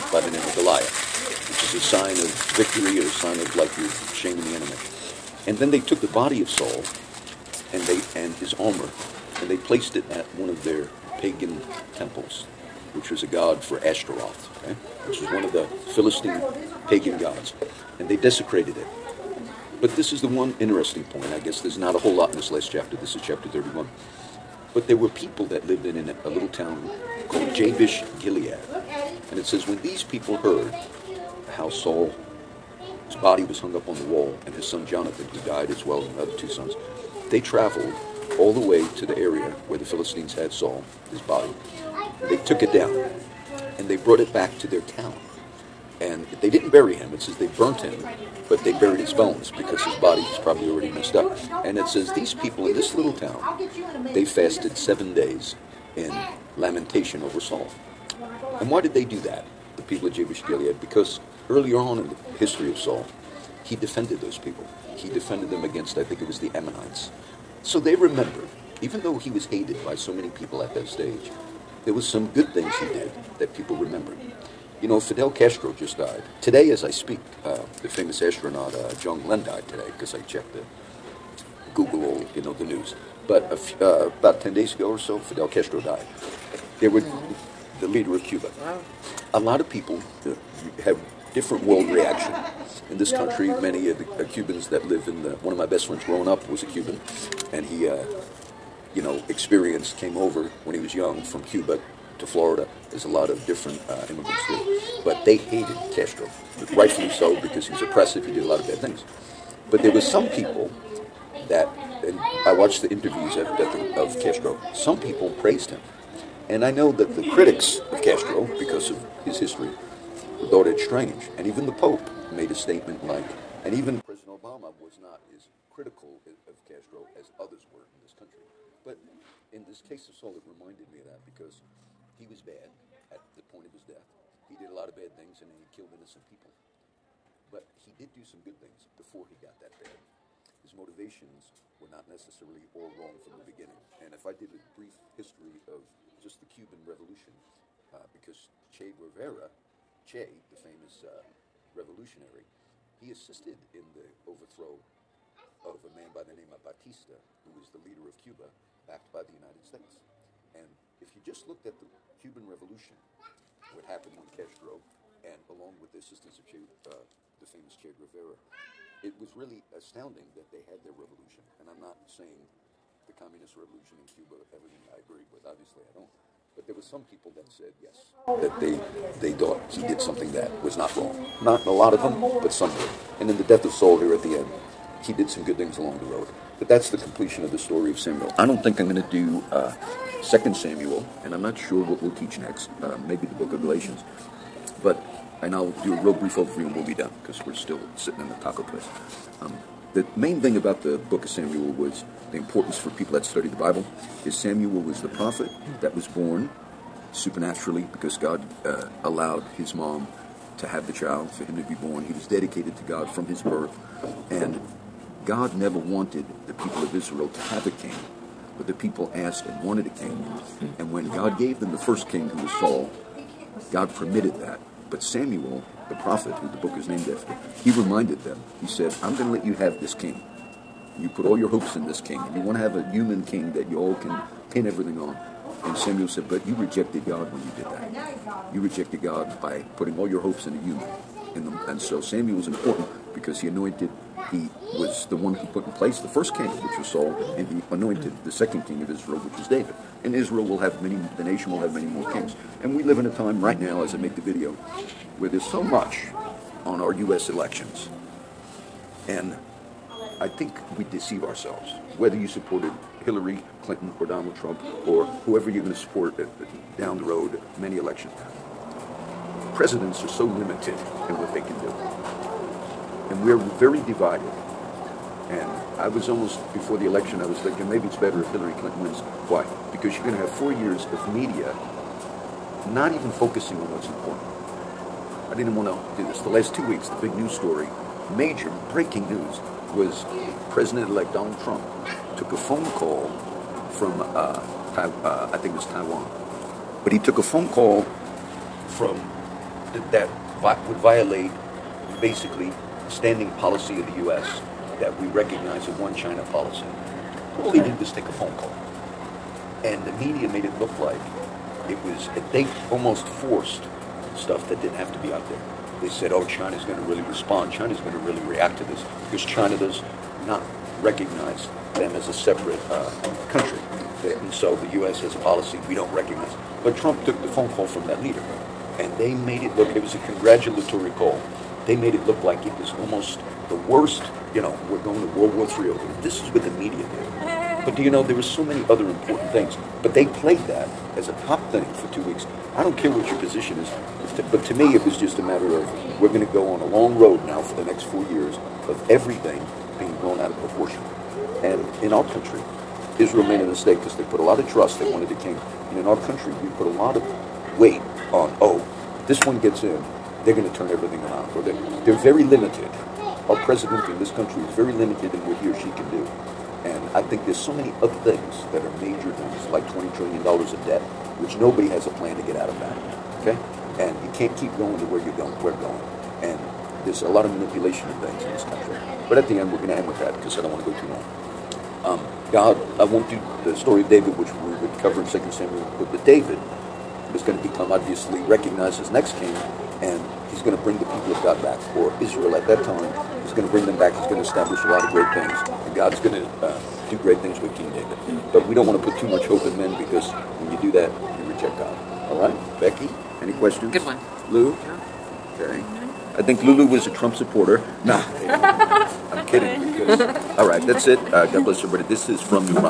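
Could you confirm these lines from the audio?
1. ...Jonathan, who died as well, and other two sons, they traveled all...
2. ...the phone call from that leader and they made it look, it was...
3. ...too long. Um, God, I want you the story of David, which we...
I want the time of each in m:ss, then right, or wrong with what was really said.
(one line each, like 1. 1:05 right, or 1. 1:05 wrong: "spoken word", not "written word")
1. 0:34 right
2. 5:27 right
3. 6:20 right.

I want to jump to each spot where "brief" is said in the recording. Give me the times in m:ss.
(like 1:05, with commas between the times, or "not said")
2:24, 3:16.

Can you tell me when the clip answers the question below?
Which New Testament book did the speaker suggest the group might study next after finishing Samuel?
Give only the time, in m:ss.
3:13.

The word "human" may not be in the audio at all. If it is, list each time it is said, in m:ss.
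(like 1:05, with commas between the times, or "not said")
3:52, 4:00.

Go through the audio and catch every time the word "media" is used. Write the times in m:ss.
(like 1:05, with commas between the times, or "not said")
4:41, 5:09, 5:36.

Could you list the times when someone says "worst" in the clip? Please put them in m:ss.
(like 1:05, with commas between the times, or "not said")
5:33.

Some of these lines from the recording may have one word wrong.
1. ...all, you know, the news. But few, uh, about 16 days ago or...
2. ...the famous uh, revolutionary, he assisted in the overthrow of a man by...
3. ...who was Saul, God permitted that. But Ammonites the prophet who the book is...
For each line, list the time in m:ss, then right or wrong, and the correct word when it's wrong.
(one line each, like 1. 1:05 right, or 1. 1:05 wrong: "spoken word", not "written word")
1. 1:22 wrong: "10", not "16"
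2. 2:30 right
3. 3:42 wrong: "Samuel", not "Ammonites".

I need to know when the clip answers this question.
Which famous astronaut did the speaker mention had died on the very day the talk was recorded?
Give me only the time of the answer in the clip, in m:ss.
1:18.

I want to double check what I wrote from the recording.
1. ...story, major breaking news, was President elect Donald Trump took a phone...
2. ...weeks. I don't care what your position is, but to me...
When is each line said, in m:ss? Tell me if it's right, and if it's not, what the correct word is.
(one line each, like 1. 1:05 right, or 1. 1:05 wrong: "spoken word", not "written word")
1. 4:47 right
2. 5:42 right.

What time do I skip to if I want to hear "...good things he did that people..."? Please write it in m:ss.
1:12.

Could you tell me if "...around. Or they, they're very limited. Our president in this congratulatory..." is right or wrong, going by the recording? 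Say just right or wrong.
wrong.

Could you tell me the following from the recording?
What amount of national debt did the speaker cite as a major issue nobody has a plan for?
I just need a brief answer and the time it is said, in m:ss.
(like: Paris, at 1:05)
$20 trillion, at 6:09.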